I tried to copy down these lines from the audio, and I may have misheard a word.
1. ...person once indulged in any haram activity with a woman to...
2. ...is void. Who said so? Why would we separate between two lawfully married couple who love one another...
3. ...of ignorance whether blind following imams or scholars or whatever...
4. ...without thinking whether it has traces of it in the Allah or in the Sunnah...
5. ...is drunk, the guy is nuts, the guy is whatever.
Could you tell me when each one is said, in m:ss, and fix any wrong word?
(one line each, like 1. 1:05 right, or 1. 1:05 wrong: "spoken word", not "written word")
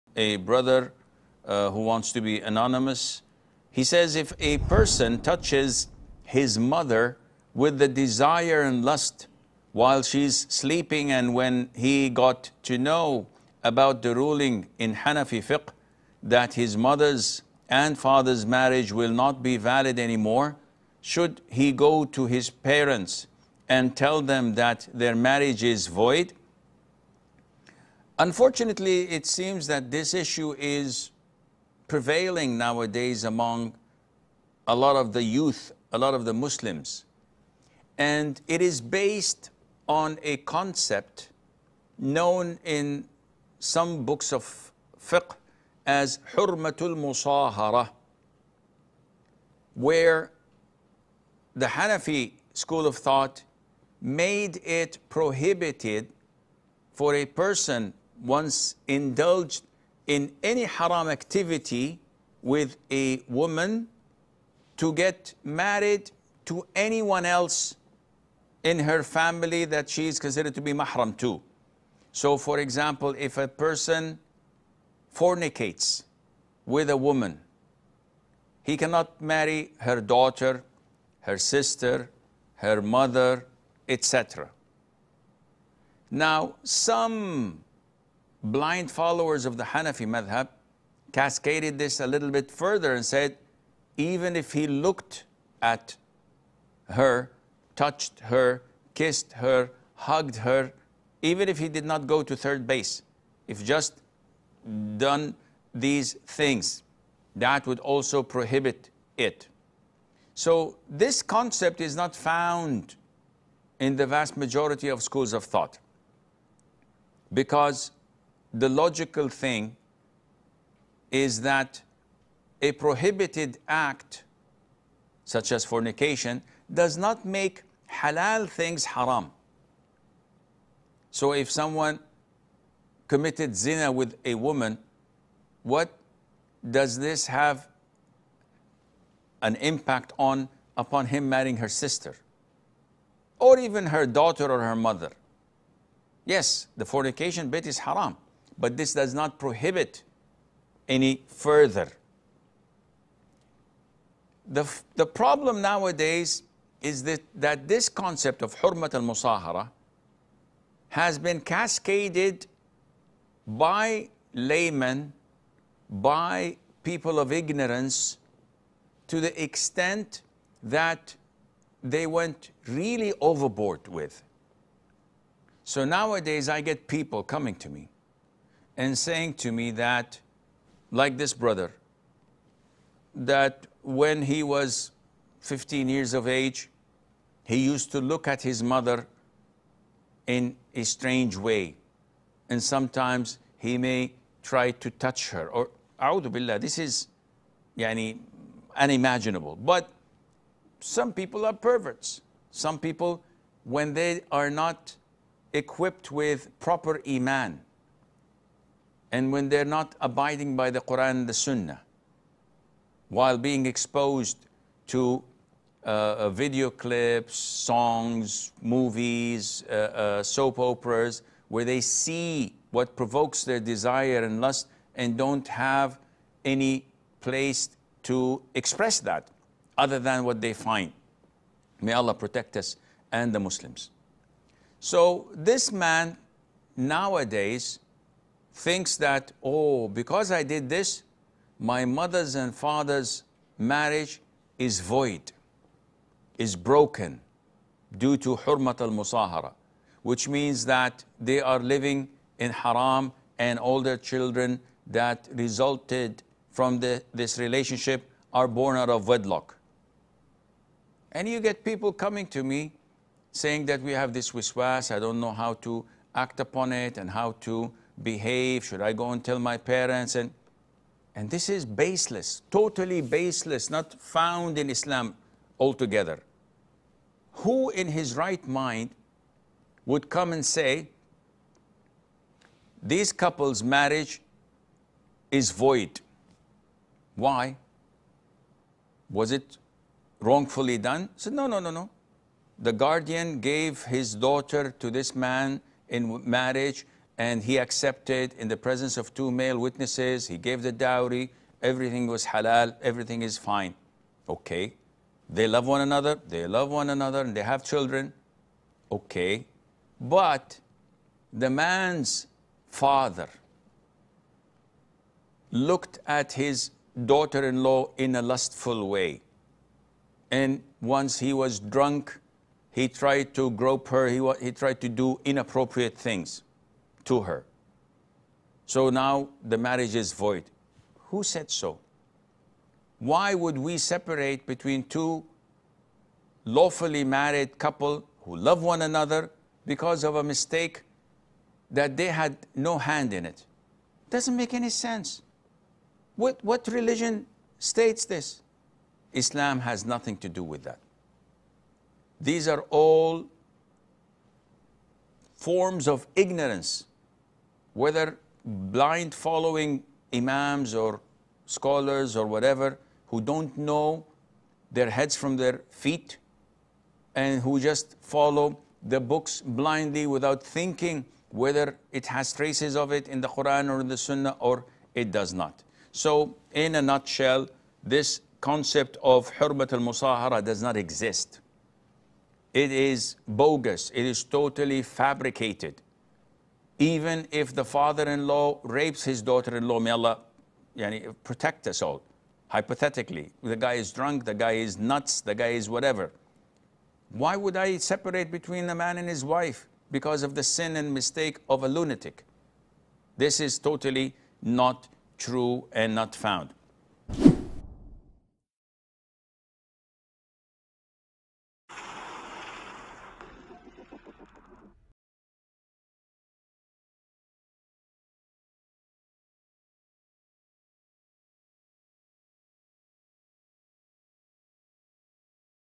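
1. 0:57 right
2. 5:29 right
3. 5:55 right
4. 6:10 wrong: "Quran", not "Allah"
5. 6:33 right.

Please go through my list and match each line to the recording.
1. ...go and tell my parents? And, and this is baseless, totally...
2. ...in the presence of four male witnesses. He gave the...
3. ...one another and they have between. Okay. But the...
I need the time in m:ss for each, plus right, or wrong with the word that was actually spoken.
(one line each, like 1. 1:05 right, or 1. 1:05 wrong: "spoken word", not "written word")
1. 4:28 right
2. 4:58 wrong: "two", not "four"
3. 5:06 wrong: "children", not "between".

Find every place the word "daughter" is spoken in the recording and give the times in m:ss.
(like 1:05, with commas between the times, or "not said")
1:20, 2:24, 4:54, 5:17, 6:29.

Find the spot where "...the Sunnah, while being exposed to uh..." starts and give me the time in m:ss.
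3:31.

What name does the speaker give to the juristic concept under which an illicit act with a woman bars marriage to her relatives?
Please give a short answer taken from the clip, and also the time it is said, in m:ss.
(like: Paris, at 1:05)
Hurmatul musahara, at 0:46.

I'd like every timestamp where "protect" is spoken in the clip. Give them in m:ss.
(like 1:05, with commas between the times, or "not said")
3:52, 6:31.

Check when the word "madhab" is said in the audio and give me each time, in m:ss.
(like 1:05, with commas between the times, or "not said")
1:30.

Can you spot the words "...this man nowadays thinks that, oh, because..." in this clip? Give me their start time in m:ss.
3:55.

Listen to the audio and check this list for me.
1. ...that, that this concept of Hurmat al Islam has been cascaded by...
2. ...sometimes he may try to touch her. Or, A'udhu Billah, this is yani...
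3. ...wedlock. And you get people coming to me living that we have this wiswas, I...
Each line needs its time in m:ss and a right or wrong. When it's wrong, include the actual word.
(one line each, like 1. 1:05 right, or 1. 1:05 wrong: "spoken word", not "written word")
1. 2:37 wrong: "Musahara", not "Islam"
2. 3:12 right
3. 4:19 wrong: "saying", not "living".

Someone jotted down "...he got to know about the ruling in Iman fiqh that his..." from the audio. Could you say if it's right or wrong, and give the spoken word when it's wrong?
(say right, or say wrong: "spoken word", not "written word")
wrong: "Hanafi", not "Iman".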